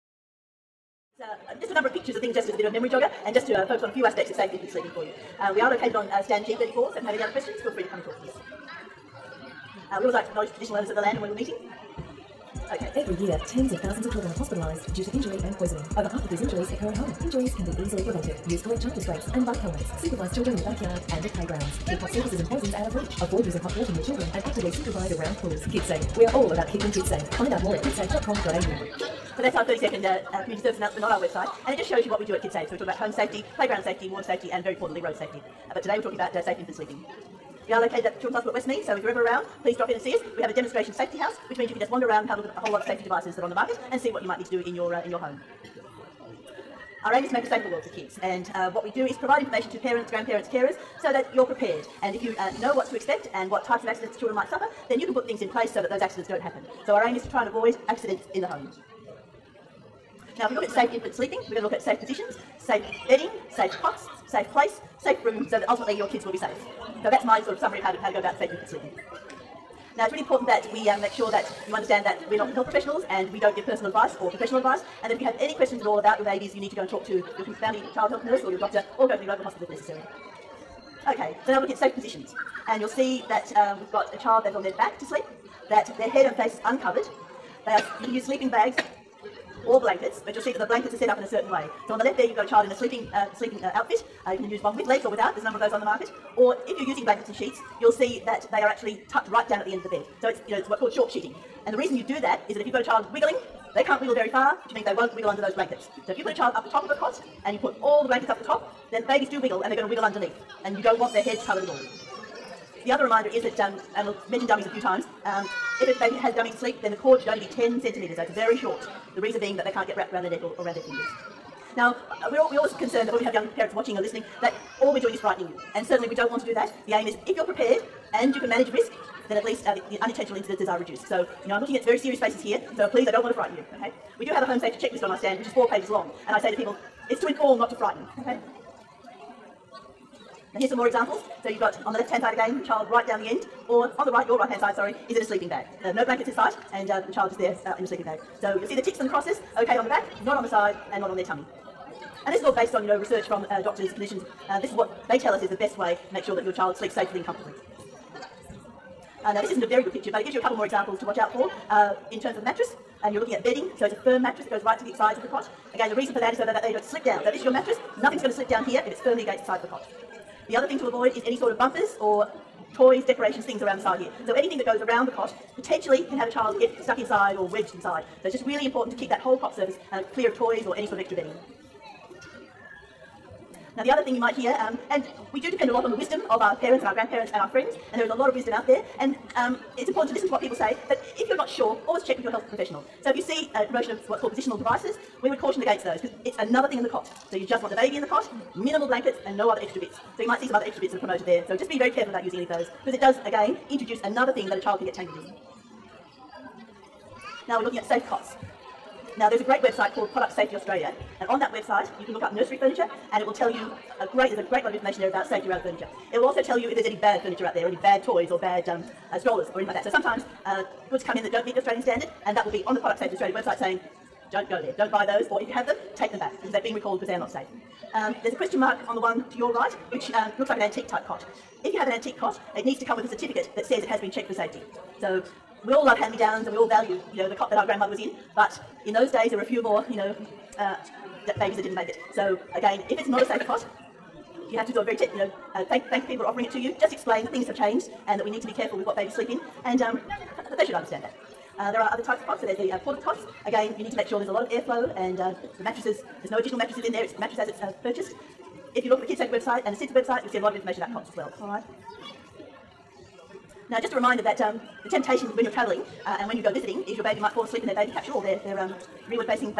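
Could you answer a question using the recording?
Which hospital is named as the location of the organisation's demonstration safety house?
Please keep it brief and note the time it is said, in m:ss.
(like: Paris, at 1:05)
Children's Hospital at Westmead, at 0:38.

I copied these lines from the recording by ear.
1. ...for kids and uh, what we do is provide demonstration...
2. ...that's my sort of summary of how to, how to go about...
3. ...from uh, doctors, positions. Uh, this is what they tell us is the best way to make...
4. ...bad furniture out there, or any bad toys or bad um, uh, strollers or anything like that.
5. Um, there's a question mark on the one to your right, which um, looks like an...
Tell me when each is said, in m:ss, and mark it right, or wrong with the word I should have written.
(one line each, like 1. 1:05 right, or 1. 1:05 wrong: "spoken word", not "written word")
1. 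0:47 wrong: "information", not "demonstration"
2. 1:07 right
3. 2:33 wrong: "clinicians", not "positions"
4. 3:36 right
5. 3:47 right.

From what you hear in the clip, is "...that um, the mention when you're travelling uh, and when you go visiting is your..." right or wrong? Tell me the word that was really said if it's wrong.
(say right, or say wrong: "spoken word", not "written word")
wrong: "temptation", not "mention".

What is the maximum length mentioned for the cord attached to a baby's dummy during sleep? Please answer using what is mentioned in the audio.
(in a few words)
10 centimetres.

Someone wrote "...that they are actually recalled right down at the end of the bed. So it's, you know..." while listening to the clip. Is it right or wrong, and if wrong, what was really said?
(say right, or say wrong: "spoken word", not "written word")
wrong: "tucked", not "recalled".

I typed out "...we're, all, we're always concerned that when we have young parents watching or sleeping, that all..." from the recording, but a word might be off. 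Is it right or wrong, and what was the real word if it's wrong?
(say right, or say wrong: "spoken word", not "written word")
wrong: "listening", not "sleeping".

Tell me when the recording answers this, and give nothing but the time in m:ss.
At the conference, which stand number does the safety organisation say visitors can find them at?
0:06.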